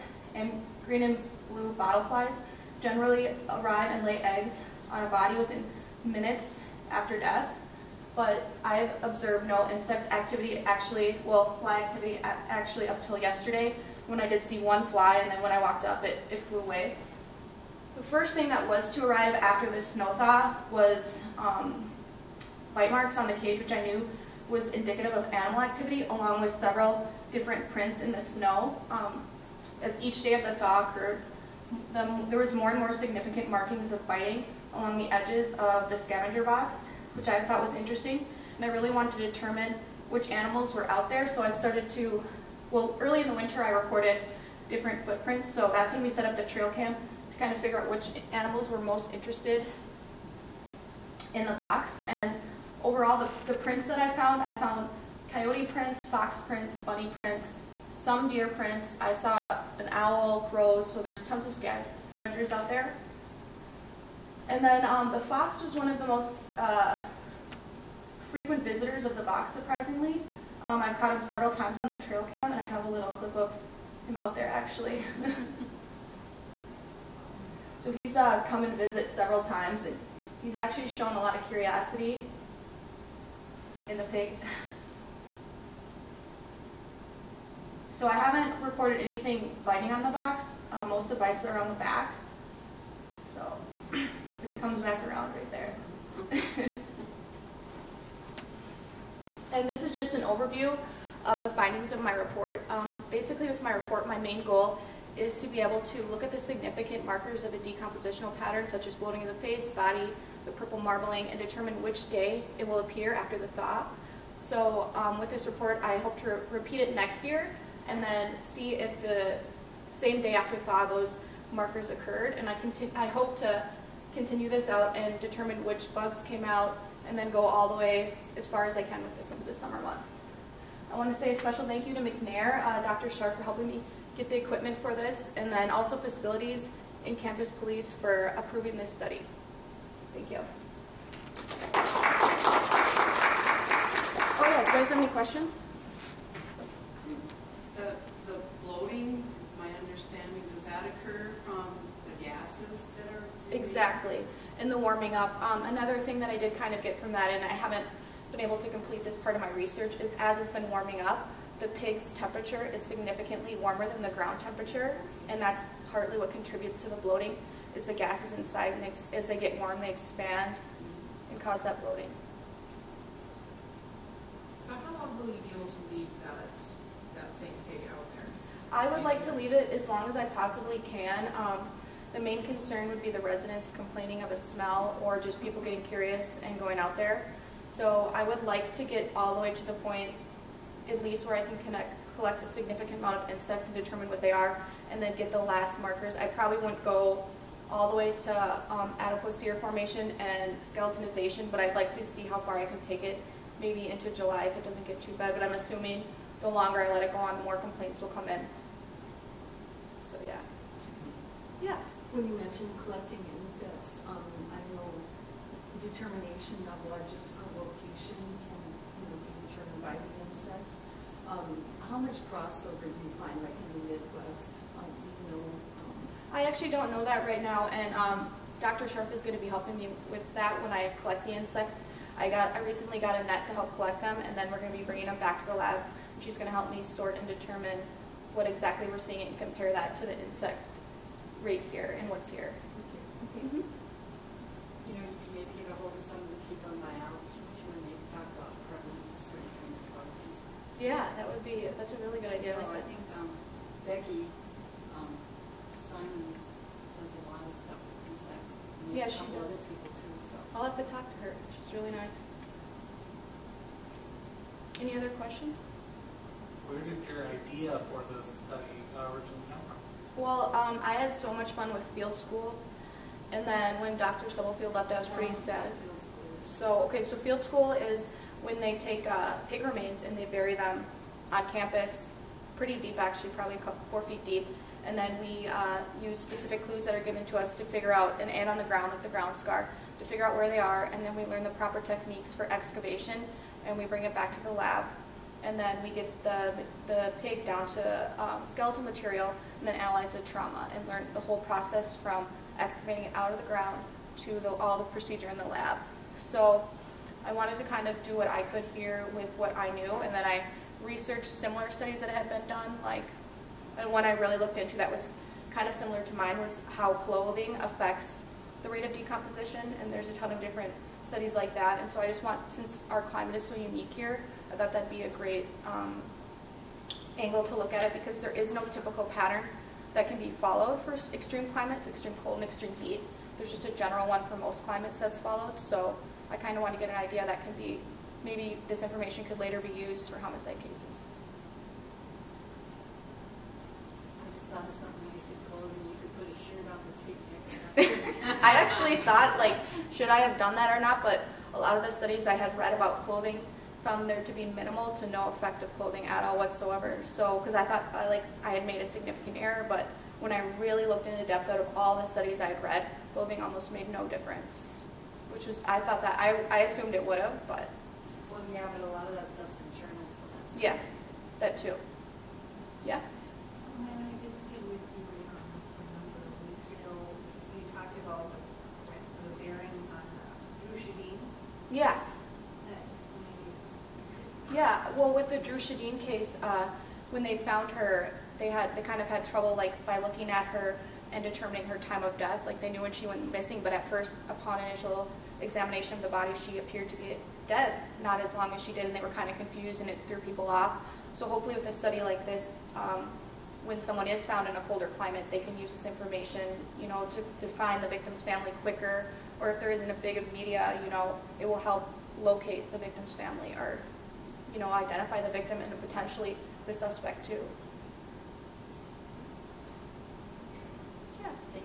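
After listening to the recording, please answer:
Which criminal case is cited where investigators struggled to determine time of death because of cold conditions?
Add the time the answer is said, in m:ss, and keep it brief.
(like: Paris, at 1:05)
Dru Sjodin, at 6:25.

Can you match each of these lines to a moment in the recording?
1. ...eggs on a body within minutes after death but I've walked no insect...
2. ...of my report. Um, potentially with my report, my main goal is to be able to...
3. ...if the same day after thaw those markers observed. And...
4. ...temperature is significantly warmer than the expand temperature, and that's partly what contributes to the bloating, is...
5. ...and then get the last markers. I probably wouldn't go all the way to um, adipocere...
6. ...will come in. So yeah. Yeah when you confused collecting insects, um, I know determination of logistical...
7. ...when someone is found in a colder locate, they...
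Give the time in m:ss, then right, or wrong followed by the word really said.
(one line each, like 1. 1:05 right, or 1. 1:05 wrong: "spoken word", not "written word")
1. 0:04 wrong: "observed", not "walked"
2. 1:41 wrong: "basically", not "potentially"
3. 1:58 wrong: "occurred", not "observed"
4. 2:42 wrong: "ground", not "expand"
5. 3:14 right
6. 3:27 wrong: "mentioned", not "confused"
7. 6:43 wrong: "climate", not "locate".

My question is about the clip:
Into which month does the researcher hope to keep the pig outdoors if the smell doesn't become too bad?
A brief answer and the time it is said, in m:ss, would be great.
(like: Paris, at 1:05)
July, at 3:24.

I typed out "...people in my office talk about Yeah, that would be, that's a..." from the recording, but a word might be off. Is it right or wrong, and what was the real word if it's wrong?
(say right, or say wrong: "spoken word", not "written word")
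right.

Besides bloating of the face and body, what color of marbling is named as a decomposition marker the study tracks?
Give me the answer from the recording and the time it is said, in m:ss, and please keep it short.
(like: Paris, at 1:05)
purple, at 1:50.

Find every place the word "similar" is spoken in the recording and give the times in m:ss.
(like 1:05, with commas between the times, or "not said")
5:11, 5:15.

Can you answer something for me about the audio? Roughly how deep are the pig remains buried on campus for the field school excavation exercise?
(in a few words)
4 feet.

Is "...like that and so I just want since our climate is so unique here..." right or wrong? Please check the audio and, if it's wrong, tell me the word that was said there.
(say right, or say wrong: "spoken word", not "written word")
right.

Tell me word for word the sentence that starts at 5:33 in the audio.
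There's just a general one for most climates that's followed.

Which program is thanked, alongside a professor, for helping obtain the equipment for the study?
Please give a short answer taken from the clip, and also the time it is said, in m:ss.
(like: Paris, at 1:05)
McNair, at 2:11.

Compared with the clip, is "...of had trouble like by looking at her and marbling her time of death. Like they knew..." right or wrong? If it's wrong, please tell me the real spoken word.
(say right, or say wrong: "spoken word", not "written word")
wrong: "determining", not "marbling".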